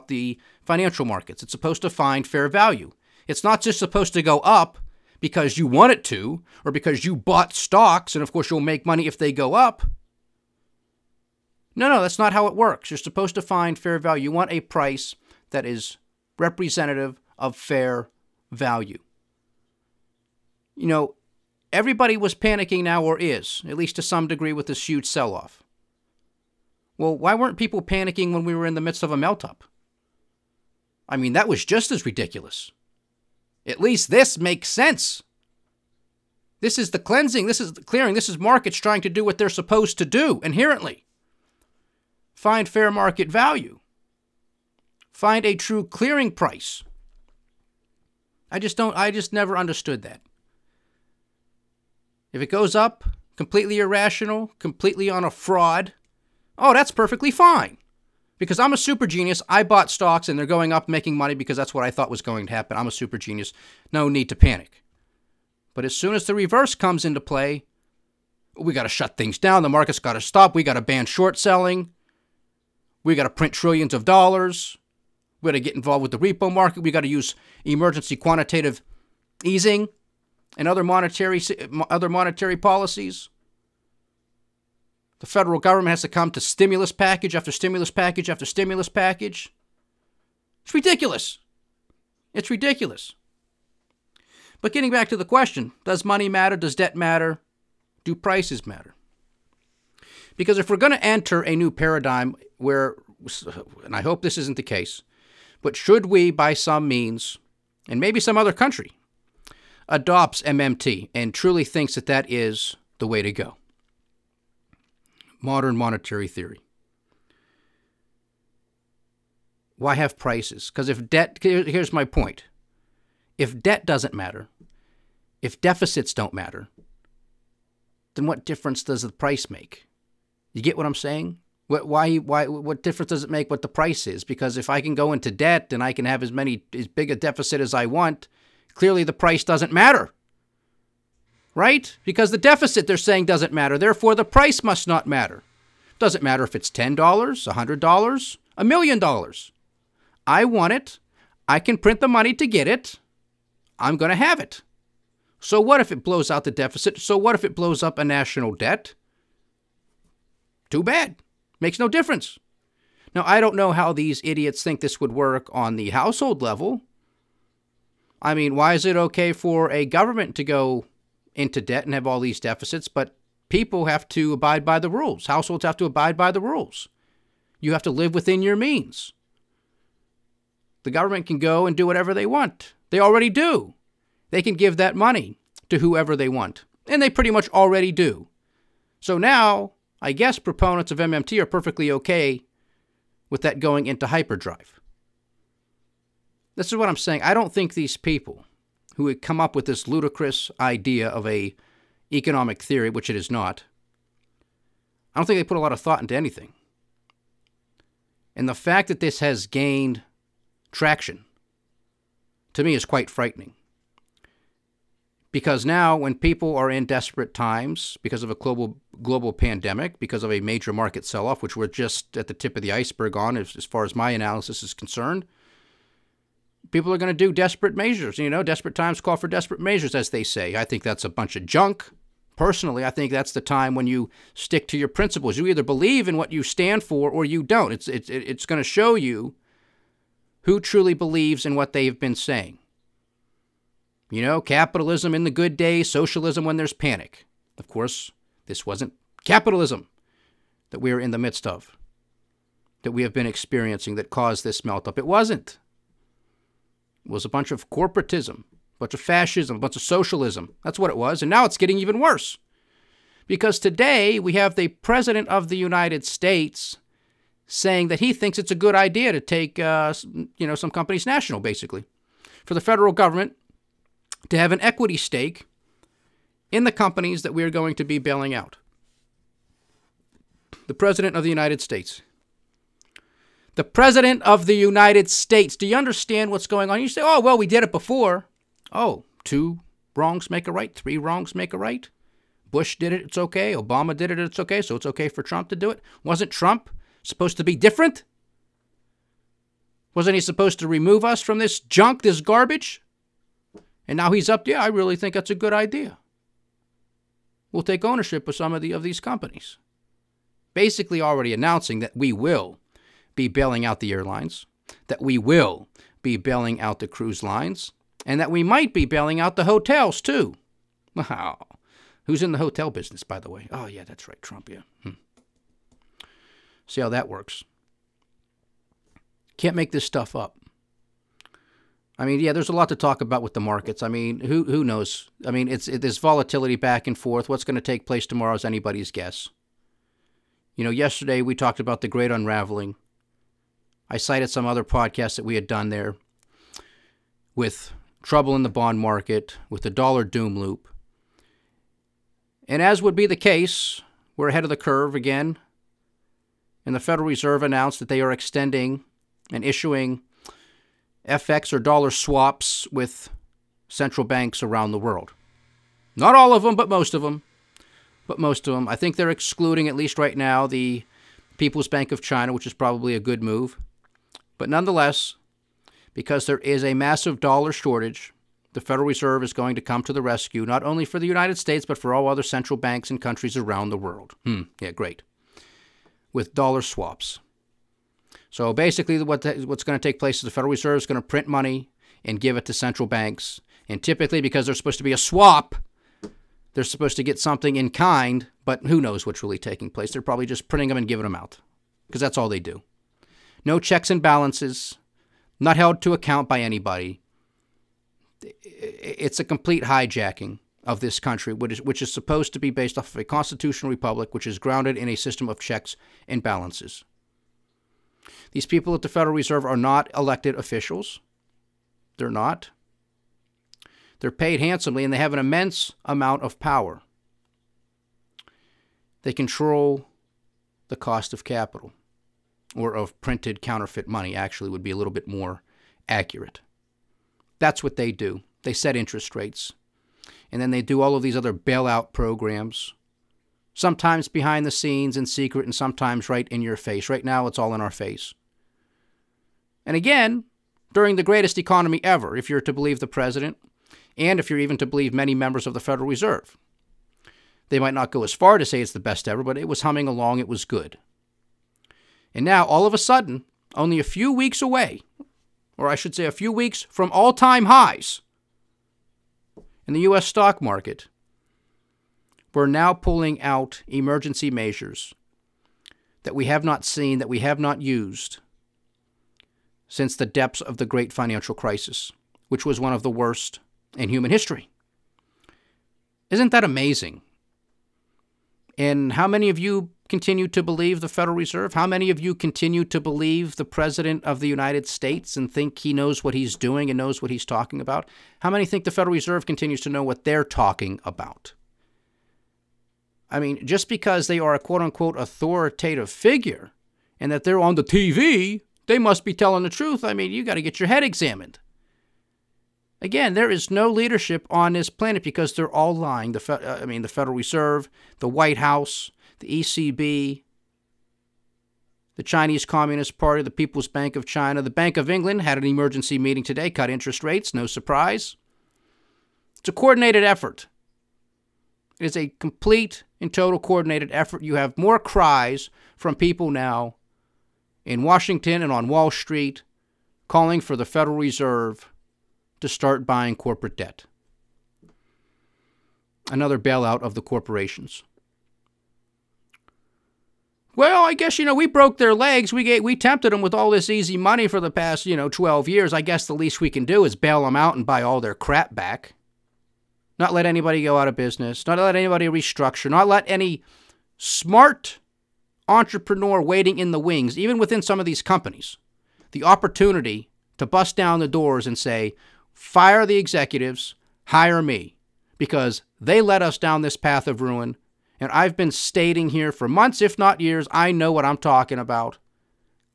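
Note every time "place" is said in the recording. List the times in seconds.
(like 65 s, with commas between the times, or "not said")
337 s, 389 s, 399 s.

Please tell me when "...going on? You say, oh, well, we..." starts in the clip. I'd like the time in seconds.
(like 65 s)
286 s.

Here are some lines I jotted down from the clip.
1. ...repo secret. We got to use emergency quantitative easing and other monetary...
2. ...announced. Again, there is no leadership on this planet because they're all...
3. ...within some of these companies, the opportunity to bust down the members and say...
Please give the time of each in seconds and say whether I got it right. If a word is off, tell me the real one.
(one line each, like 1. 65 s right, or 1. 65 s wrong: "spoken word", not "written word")
1. 76 s wrong: "market", not "secret"
2. 510 s wrong: "examined", not "announced"
3. 567 s wrong: "doors", not "members".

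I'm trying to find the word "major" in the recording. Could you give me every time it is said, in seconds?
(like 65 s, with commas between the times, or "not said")
220 s.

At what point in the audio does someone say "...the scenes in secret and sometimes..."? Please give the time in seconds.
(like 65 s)
444 s.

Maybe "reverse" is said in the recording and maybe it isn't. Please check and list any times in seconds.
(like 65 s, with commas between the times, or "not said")
66 s.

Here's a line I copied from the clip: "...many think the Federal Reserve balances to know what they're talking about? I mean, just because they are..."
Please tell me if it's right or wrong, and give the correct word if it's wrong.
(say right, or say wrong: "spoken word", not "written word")
wrong: "continues", not "balances".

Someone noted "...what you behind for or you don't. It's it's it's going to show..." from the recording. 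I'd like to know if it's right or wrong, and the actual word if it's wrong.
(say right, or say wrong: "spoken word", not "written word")
wrong: "stand", not "behind".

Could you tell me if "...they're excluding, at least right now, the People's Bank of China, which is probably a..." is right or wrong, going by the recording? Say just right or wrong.
right.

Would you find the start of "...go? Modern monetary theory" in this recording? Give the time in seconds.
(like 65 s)
113 s.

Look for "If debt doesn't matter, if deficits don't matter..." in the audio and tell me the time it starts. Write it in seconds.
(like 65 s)
123 s.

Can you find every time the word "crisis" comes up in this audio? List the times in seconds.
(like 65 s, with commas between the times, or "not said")
481 s.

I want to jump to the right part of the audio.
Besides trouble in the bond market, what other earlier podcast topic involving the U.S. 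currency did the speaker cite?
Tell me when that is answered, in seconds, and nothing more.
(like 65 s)
349 s.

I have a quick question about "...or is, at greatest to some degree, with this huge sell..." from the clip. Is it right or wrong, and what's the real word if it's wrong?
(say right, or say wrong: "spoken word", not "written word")
wrong: "least", not "greatest".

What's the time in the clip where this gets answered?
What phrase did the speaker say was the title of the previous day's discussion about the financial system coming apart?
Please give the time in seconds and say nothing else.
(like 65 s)
341 s.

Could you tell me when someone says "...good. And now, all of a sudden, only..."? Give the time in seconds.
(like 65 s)
460 s.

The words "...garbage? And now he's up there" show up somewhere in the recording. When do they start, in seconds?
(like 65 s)
302 s.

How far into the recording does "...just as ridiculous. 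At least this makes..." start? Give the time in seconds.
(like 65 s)
31 s.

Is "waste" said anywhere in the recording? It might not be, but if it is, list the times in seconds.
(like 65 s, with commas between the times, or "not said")
not said.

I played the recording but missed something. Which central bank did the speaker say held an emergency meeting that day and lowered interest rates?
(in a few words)
Bank of England.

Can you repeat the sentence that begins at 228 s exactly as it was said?
You know, desperate times call for desperate measures, as they say.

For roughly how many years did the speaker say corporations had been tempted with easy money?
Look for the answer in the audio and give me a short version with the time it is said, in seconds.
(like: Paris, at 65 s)
12, at 555 s.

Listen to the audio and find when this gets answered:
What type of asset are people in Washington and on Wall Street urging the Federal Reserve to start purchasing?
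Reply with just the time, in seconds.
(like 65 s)
543 s.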